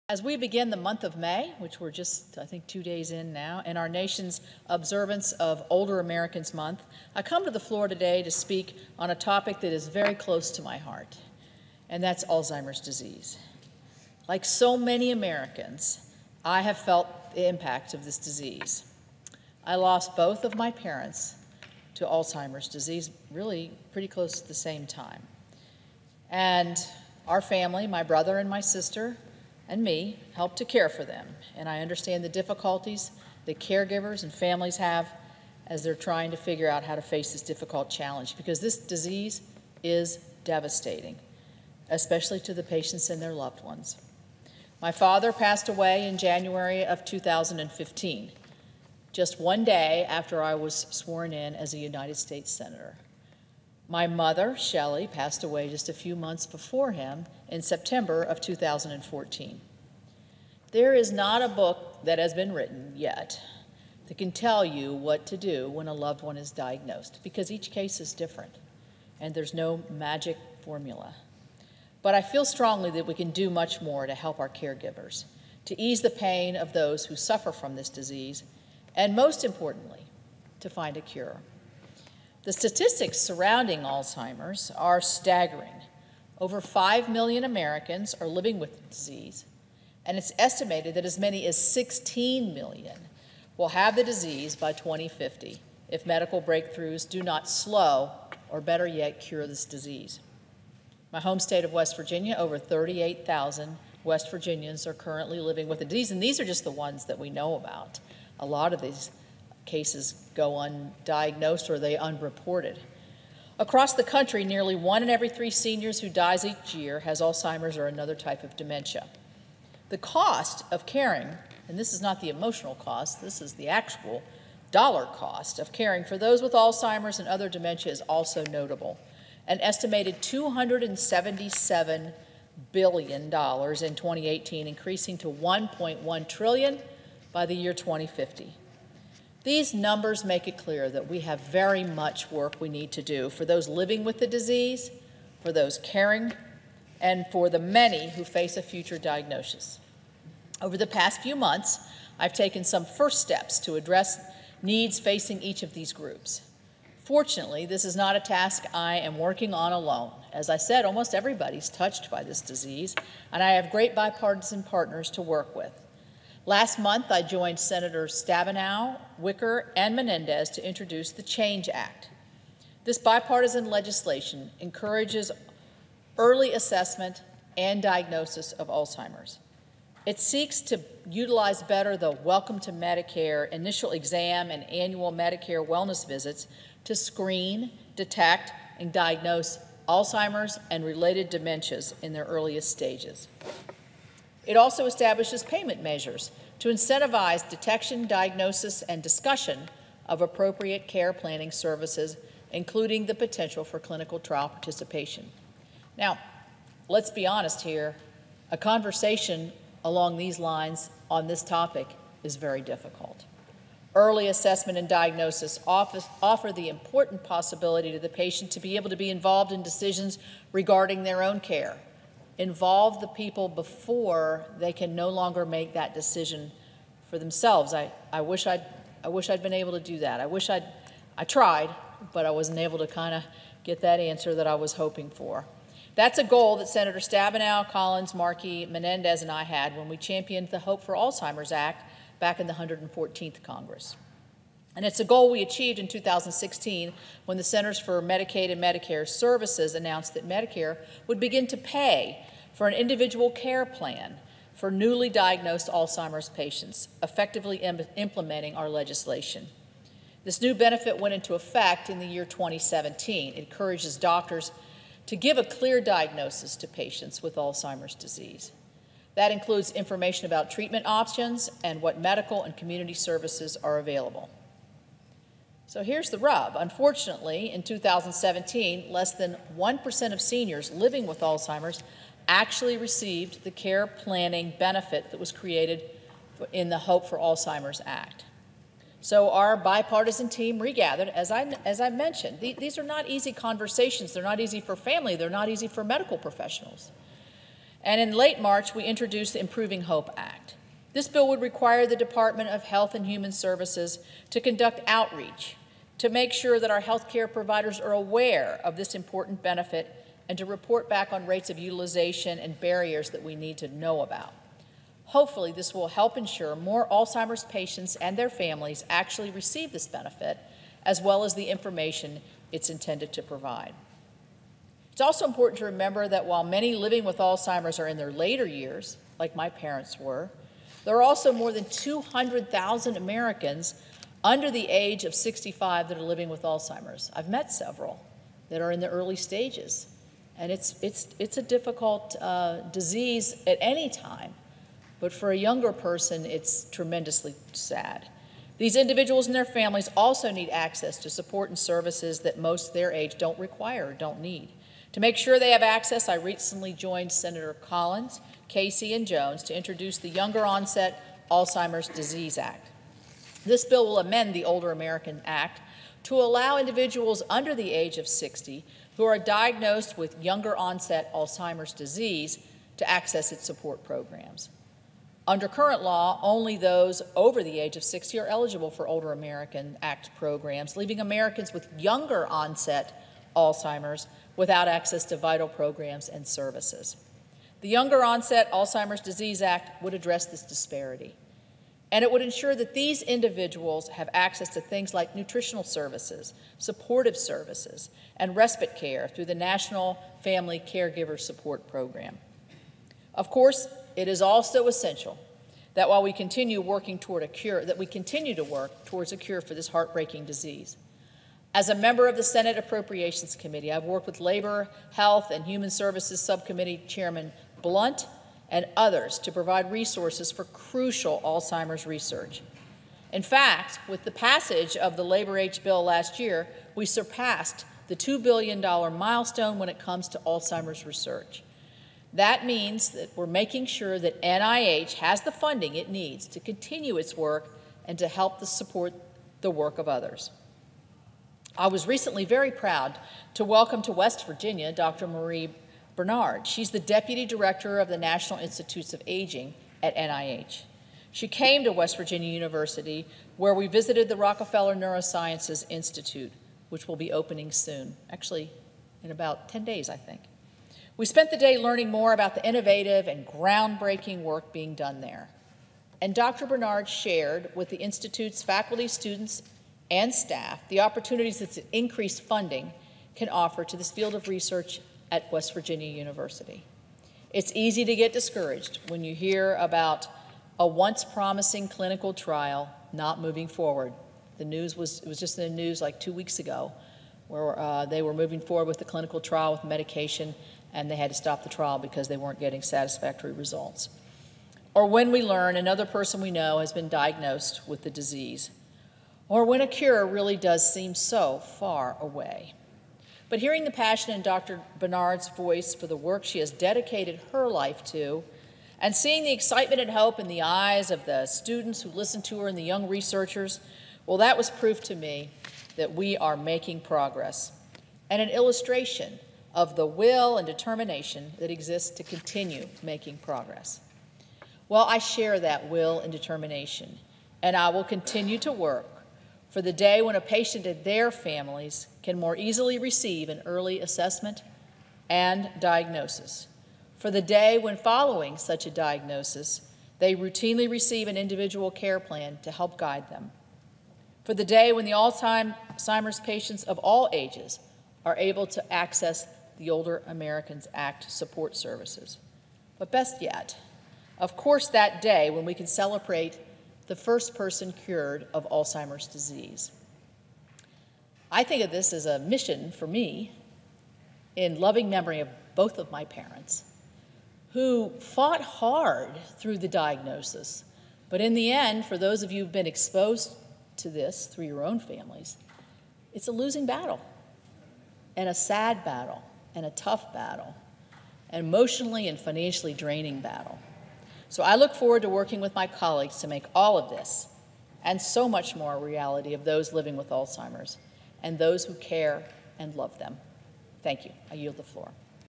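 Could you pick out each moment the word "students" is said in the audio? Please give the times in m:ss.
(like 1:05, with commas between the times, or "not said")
7:48, 8:31.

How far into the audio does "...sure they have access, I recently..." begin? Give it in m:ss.
5:55.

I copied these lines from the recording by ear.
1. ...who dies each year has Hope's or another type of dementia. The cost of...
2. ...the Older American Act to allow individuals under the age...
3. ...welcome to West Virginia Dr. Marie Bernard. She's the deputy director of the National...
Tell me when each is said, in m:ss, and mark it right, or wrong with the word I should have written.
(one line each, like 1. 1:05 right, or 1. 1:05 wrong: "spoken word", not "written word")
1. 1:55 wrong: "Alzheimer", not "Hope"
2. 6:04 right
3. 7:23 right.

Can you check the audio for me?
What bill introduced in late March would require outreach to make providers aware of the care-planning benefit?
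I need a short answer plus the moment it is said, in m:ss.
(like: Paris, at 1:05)
Improving Hope Act, at 4:59.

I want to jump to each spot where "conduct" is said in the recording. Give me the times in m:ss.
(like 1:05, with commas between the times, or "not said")
5:04.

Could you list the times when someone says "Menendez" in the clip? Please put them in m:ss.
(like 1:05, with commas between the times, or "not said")
2:49, 3:58.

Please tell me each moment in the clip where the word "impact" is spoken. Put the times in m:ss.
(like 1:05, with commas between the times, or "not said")
0:17.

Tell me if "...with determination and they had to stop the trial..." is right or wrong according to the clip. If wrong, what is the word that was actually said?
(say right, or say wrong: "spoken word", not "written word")
wrong: "medication", not "determination".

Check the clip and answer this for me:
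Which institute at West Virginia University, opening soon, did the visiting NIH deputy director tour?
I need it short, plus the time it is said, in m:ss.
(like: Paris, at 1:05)
Rockefeller Neurosciences Institute, at 7:34.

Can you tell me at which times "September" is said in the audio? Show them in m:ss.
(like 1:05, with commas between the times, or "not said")
0:57.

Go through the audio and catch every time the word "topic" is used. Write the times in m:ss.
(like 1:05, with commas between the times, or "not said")
0:09, 3:31.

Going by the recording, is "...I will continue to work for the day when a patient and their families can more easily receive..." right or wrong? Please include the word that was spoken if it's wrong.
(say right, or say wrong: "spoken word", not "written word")
right.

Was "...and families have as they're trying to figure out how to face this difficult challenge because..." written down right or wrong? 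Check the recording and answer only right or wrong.
right.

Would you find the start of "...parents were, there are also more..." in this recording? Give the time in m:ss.
5:29.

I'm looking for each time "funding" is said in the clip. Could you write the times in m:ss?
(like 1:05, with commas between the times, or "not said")
7:15, 7:52.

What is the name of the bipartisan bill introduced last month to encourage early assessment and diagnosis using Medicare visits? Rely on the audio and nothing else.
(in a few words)
Change Act.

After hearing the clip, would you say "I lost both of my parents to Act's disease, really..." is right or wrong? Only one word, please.
wrong.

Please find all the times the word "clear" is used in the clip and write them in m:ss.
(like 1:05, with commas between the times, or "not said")
2:20, 4:25.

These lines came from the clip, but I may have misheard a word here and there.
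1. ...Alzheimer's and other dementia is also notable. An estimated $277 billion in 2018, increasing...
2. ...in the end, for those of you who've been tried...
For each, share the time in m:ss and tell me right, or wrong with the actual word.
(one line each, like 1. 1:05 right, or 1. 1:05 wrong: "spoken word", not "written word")
1. 2:06 right
2. 9:31 wrong: "exposed", not "tried".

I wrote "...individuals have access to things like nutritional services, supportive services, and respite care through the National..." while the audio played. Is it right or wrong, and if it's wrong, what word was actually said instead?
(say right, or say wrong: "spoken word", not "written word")
right.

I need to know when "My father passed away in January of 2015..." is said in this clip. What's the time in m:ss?
0:44.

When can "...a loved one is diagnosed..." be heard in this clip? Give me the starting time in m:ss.
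1:05.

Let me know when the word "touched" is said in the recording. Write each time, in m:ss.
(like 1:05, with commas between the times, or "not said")
2:41.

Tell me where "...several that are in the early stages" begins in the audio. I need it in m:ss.
5:37.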